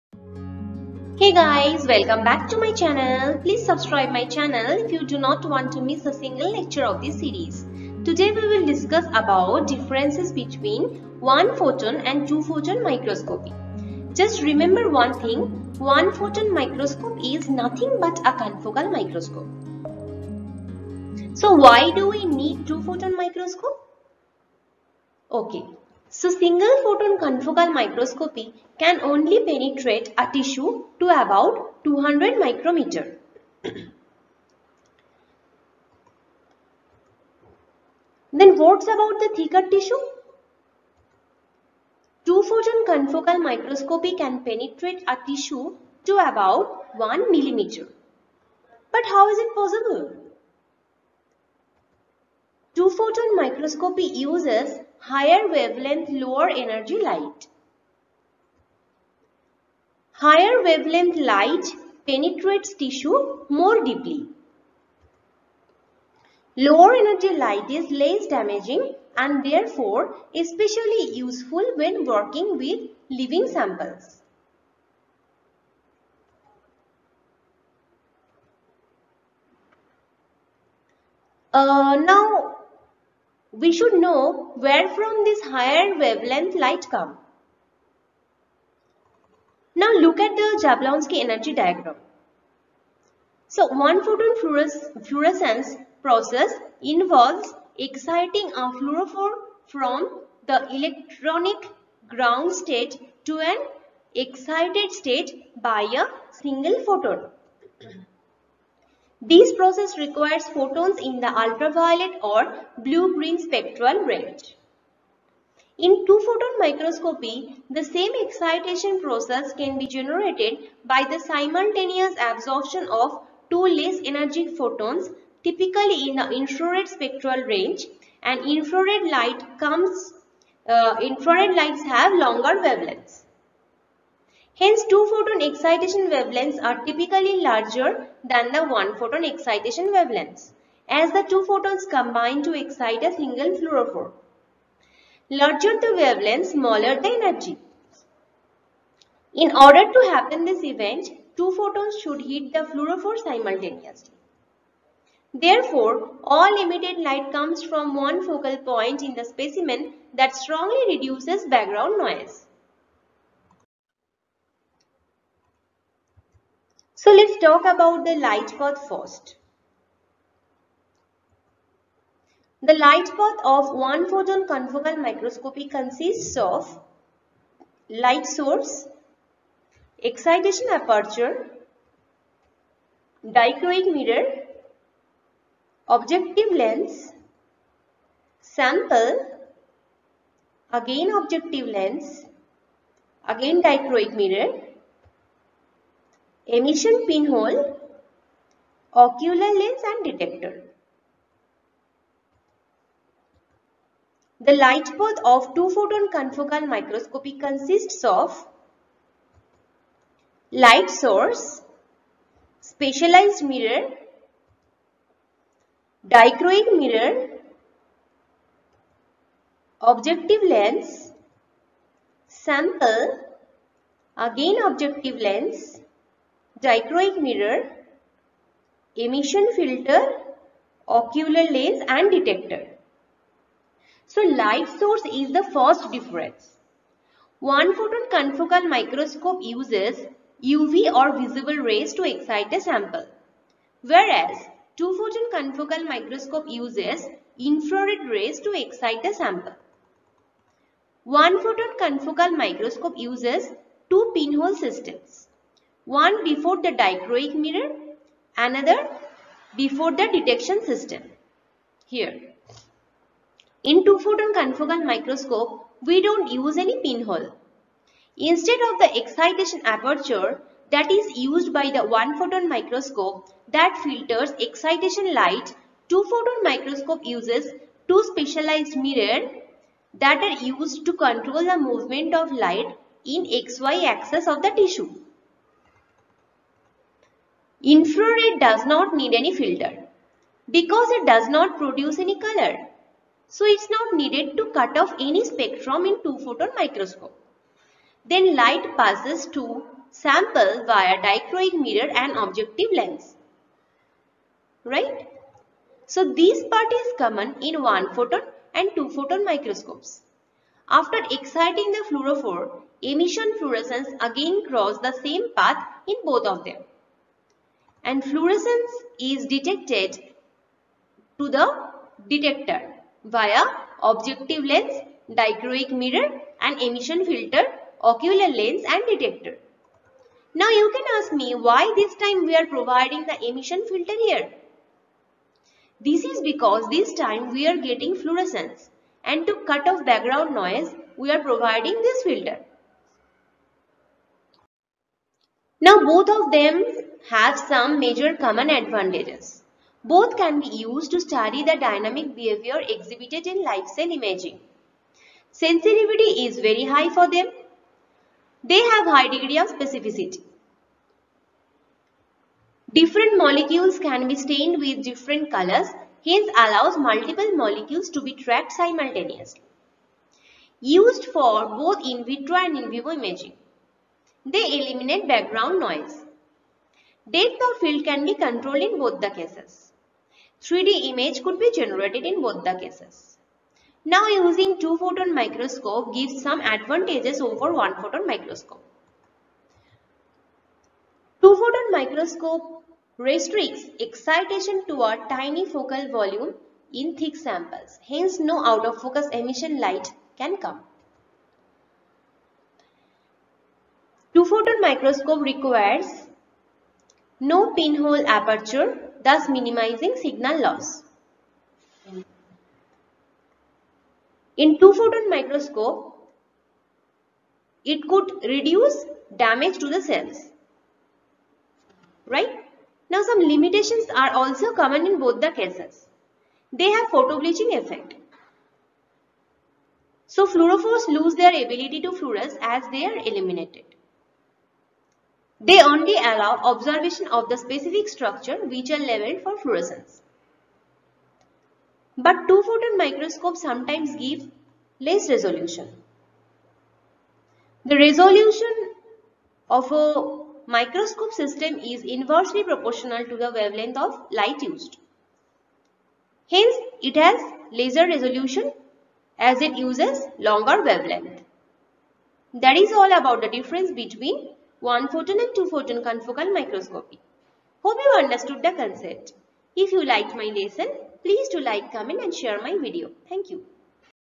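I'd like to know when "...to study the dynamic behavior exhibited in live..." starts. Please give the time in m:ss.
5:50.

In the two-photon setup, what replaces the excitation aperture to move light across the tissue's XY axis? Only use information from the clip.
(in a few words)
specialized mirrors.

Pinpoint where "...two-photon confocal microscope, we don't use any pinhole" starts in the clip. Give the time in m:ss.
4:23.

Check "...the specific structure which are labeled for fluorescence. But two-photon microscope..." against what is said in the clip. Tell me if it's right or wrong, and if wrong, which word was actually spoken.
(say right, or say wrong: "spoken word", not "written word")
right.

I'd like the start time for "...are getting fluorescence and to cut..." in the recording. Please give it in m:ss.
5:37.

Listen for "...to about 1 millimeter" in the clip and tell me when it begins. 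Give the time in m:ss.
0:46.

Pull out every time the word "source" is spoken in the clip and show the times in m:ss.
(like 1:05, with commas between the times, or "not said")
2:58, 3:30, 3:54.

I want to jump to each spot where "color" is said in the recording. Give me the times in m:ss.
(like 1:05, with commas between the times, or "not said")
4:52, 6:05.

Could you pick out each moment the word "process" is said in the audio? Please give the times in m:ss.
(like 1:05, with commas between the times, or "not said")
1:36, 1:49, 1:58.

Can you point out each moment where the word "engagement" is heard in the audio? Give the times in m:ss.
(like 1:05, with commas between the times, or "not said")
not said.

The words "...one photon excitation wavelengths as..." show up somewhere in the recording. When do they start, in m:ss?
2:18.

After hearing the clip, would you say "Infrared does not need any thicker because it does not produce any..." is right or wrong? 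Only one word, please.
wrong.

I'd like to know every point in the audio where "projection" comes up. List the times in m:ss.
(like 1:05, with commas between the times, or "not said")
not said.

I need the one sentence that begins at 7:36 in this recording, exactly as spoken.
Hence, it has laser resolution as it uses longer wavelength.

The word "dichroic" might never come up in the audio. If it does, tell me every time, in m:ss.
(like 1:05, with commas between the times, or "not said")
3:03, 3:13, 3:36, 3:46, 4:16, 5:01, 5:25.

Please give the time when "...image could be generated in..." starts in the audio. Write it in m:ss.
6:20.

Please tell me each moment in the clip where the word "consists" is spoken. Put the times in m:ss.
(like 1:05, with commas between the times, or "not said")
2:55, 3:27.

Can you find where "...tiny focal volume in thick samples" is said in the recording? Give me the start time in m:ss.
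6:35.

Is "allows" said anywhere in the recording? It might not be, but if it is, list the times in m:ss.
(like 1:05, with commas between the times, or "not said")
6:06, 7:15.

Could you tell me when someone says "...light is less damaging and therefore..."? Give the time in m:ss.
1:07.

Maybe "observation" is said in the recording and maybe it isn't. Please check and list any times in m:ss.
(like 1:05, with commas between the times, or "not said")
7:16.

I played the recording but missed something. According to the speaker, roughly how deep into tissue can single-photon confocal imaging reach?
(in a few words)
200 micrometers.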